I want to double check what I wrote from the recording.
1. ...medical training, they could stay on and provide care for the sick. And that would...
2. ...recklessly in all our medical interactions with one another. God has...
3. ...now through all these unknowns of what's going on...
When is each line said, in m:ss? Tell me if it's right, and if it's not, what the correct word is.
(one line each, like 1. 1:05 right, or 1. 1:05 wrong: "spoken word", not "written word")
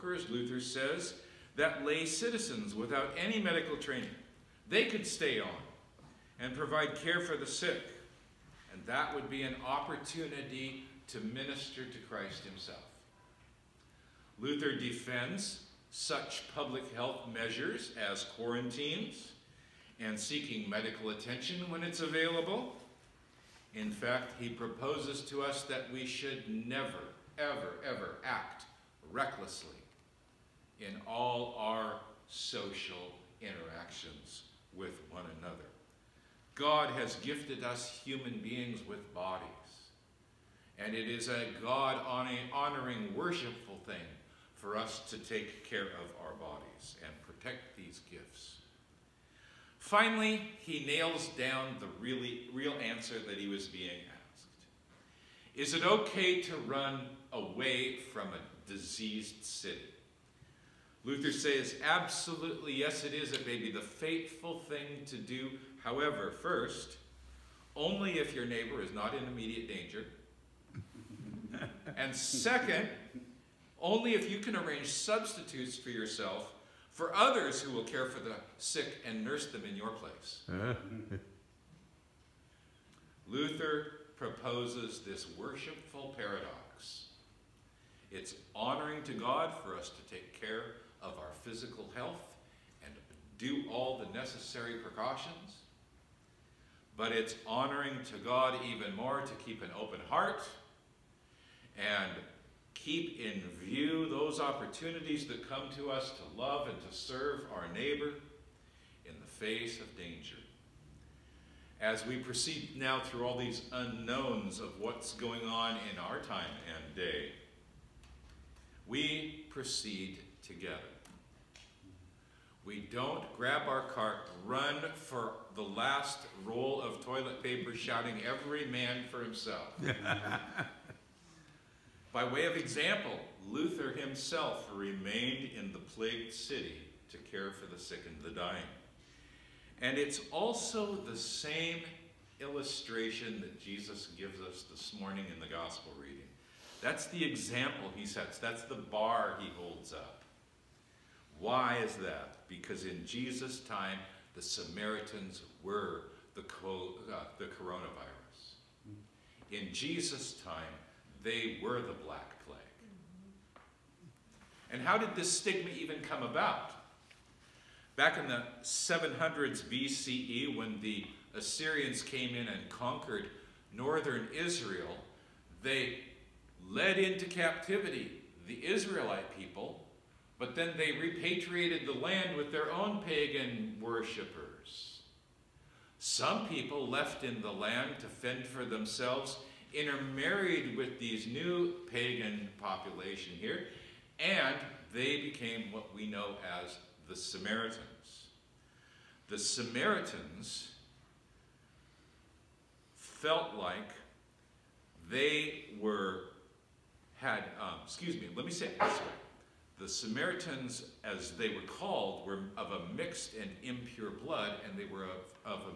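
1. 0:03 right
2. 0:29 wrong: "social", not "medical"
3. 1:52 right.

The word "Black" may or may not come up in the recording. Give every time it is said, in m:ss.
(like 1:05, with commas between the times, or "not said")
2:42.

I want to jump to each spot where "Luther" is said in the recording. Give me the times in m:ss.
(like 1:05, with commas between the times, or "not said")
0:00, 0:14, 1:01, 1:23, 2:13.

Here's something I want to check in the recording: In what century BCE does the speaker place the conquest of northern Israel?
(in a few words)
700s BCE.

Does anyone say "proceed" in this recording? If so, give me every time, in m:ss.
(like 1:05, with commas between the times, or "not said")
1:52, 1:59.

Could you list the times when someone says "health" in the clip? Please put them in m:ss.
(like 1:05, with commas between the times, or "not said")
0:16, 1:31.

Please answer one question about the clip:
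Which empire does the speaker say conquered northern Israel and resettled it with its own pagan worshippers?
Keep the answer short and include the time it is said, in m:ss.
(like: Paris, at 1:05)
Assyrians, at 2:50.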